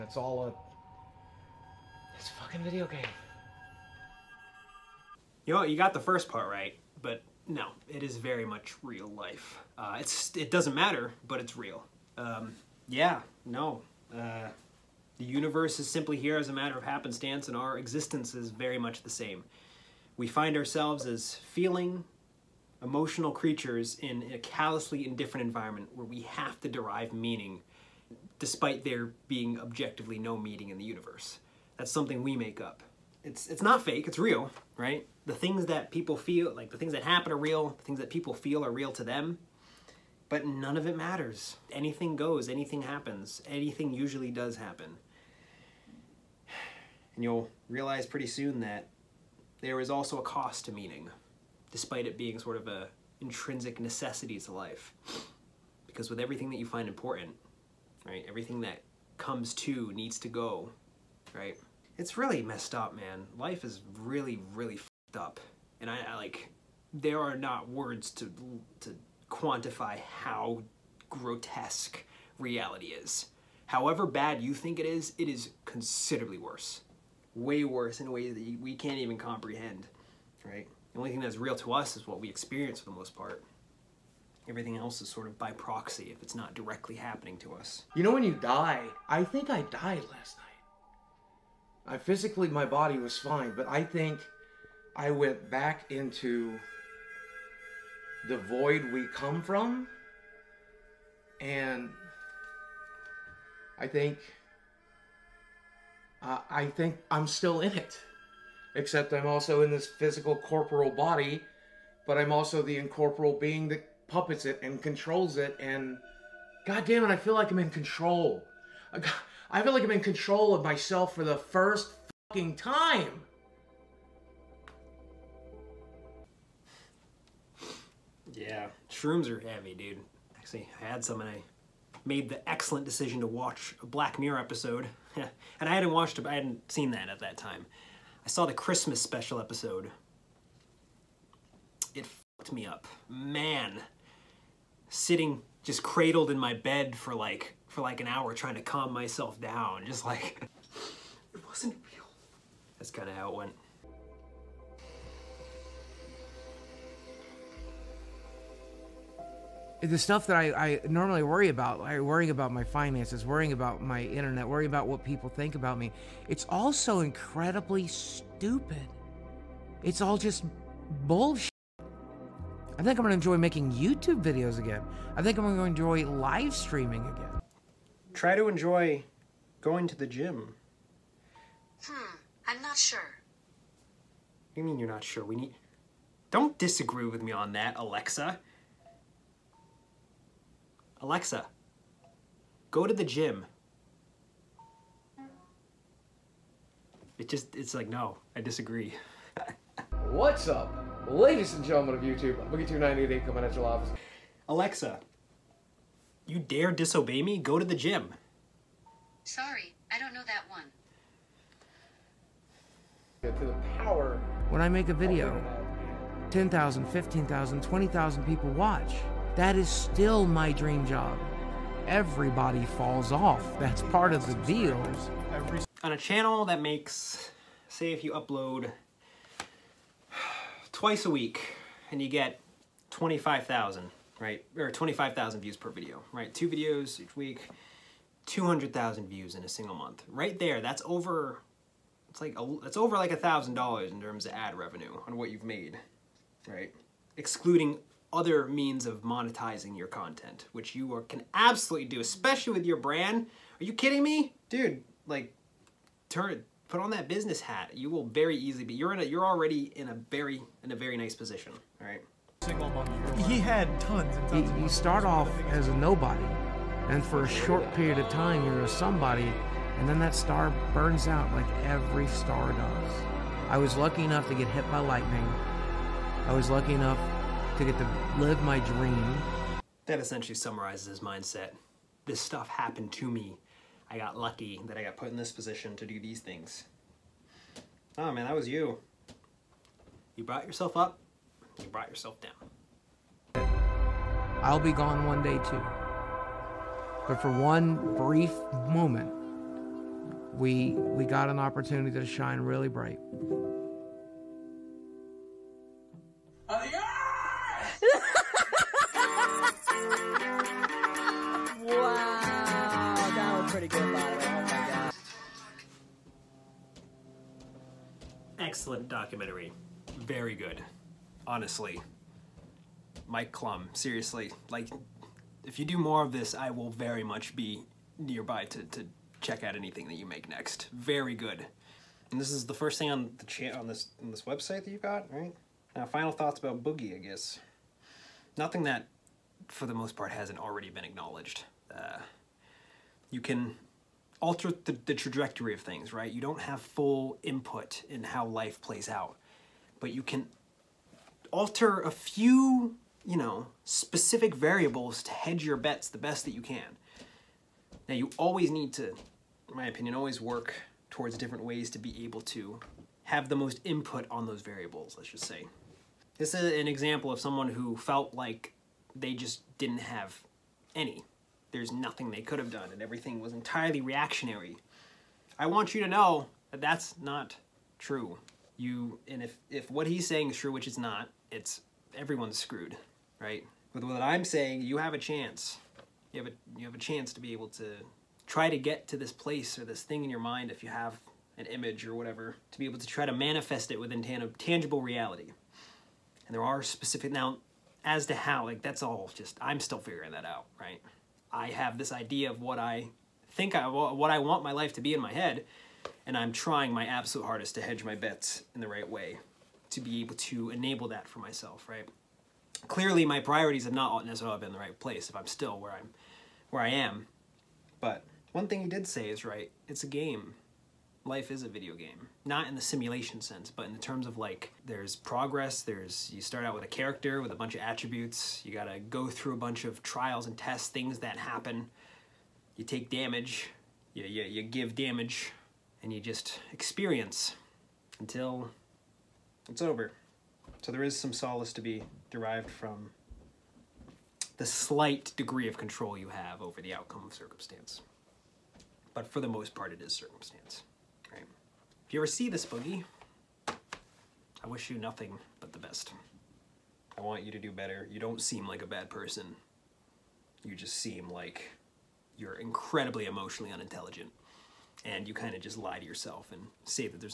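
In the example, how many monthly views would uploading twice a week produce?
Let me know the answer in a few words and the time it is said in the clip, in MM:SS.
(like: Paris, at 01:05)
200,000, at 03:58.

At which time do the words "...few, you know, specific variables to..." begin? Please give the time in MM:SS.
05:51.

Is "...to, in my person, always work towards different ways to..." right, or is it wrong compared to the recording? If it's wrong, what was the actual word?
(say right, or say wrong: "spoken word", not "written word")
wrong: "opinion", not "person".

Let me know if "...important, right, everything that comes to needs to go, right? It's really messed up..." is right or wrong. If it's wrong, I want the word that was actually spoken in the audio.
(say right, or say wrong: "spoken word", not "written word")
right.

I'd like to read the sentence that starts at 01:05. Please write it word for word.
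And I, I like, there are not words to, to quantify how grotesque reality is.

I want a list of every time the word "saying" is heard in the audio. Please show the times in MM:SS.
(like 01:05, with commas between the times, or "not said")
06:20, 06:24.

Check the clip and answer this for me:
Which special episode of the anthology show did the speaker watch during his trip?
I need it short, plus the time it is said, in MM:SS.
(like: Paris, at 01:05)
The Christmas special, at 02:18.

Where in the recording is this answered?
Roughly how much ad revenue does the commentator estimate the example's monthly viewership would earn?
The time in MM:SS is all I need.
04:03.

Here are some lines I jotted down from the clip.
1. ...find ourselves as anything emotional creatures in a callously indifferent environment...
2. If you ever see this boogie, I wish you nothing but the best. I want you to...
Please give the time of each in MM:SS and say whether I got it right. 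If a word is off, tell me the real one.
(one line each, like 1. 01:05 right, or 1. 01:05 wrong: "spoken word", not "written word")
1. 00:20 wrong: "feeling", not "anything"
2. 07:31 right.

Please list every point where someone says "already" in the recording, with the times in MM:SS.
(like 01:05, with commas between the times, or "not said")
04:19, 05:40.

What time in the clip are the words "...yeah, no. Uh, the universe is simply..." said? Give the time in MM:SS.
00:12.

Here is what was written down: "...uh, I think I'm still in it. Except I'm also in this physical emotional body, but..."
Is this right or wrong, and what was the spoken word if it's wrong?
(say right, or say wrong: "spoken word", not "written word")
wrong: "corporal", not "emotional".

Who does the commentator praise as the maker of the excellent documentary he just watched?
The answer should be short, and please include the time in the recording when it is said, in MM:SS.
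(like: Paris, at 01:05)
Mike Clum, at 05:23.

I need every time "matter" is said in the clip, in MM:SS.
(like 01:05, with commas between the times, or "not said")
00:10, 00:16, 00:40.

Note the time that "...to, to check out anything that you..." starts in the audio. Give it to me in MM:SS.
05:28.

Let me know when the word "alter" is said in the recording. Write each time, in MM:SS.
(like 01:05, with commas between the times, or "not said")
05:44, 05:51.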